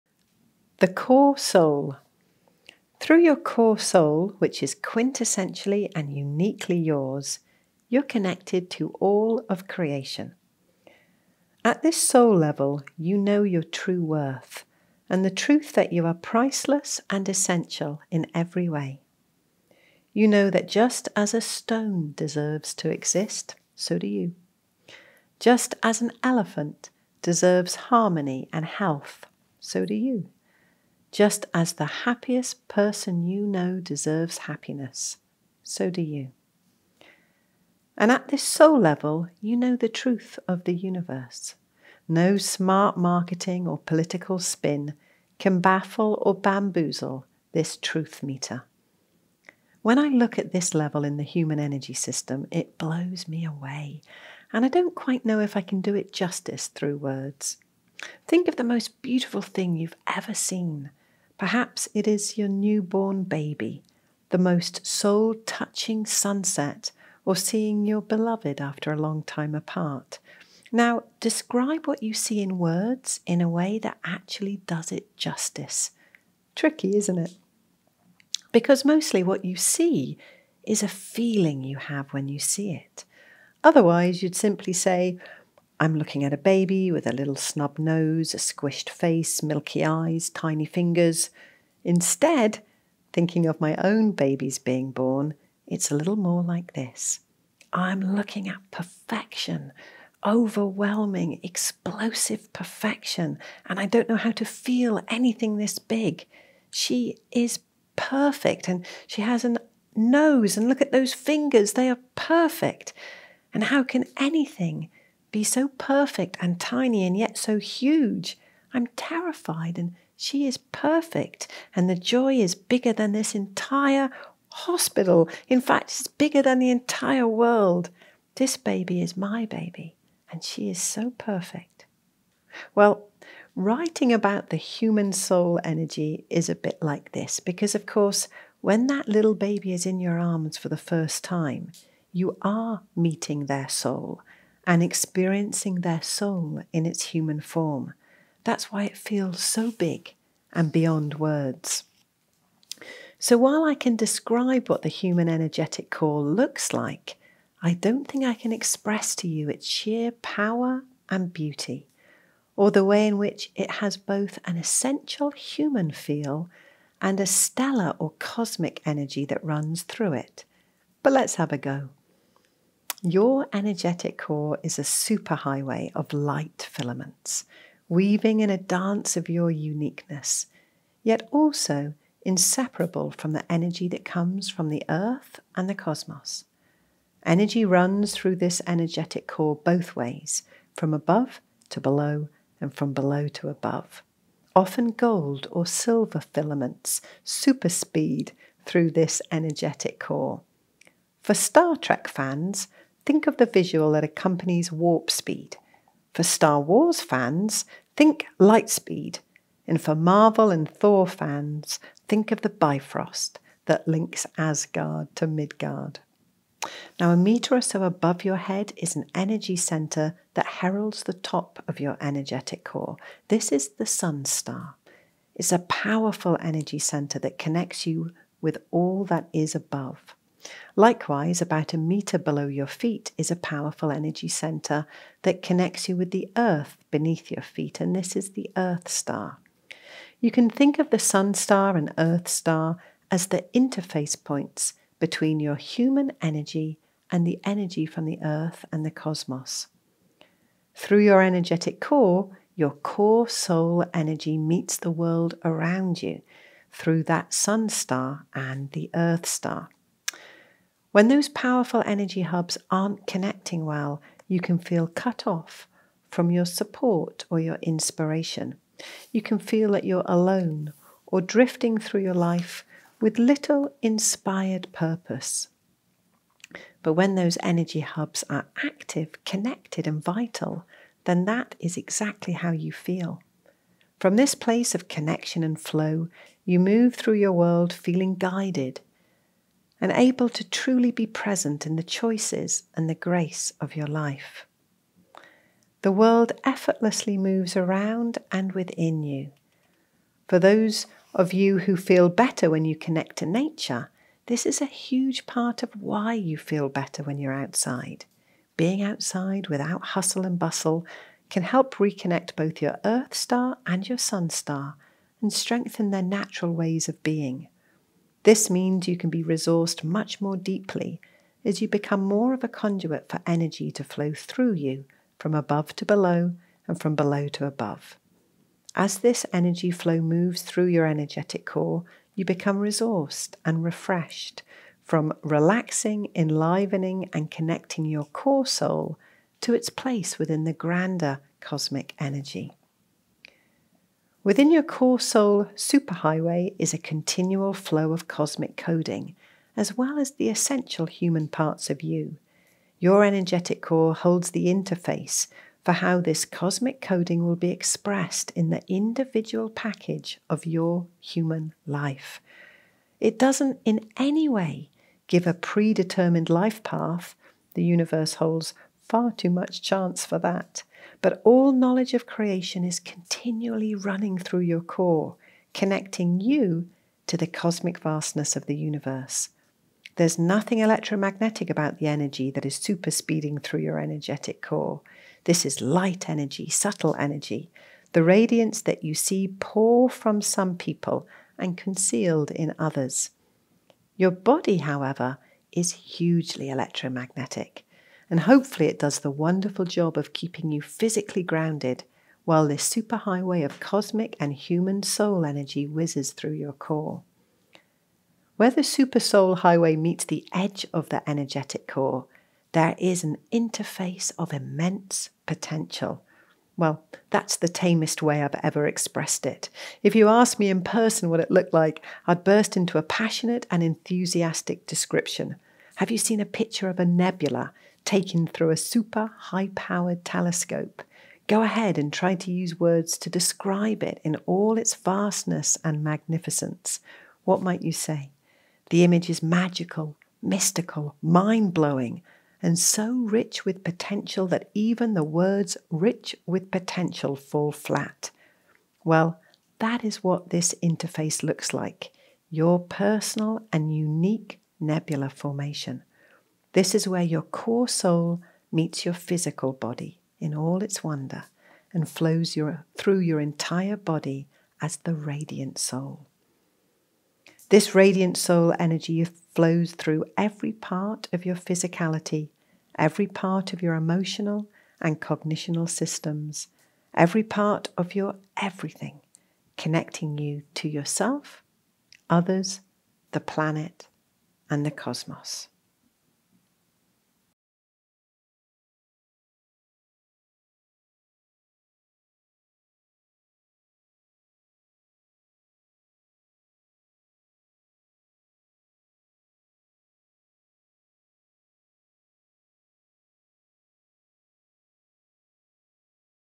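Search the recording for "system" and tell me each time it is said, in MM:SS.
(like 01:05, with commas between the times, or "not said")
00:51, 07:55.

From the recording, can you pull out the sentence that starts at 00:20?
You know that just as a stone deserves to exist, so do you.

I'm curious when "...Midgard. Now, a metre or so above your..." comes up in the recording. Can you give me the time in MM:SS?
03:35.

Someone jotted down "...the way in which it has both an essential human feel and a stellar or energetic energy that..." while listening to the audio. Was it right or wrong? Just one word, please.
wrong.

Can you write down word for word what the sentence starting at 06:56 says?
Well, that's the tamest way I've ever expressed it.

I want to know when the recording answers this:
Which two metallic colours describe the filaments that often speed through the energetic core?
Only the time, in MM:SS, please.
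03:14.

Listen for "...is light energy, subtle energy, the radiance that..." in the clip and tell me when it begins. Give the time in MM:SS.
06:25.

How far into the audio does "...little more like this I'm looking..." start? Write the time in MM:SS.
01:35.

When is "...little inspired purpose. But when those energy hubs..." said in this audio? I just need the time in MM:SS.
04:33.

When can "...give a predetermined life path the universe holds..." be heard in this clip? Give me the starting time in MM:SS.
06:05.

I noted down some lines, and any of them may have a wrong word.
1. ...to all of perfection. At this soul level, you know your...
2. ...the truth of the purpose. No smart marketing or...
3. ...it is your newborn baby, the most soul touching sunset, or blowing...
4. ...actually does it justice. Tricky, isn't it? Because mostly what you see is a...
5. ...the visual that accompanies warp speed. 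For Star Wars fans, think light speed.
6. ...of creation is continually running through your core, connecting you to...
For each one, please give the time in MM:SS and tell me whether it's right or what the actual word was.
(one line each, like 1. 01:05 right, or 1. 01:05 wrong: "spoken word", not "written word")
1. 00:08 wrong: "creation", not "perfection"
2. 00:39 wrong: "universe", not "purpose"
3. 01:01 wrong: "seeing", not "blowing"
4. 01:14 right
5. 03:23 right
6. 06:11 right.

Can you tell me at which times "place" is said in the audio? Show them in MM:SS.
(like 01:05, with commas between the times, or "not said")
04:44, 05:39.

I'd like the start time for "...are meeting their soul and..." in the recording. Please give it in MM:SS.
02:22.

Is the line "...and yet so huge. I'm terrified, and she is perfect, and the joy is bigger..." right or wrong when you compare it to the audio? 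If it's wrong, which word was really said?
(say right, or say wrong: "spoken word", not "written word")
right.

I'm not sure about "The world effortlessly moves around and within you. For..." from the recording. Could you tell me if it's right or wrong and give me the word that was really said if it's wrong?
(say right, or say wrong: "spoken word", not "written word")
right.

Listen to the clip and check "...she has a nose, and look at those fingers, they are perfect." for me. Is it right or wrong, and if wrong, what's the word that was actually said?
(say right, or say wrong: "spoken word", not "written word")
right.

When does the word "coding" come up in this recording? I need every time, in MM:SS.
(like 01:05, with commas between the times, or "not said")
05:48, 05:56.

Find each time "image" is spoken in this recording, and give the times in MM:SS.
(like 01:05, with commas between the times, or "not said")
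07:18.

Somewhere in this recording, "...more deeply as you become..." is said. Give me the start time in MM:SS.
05:20.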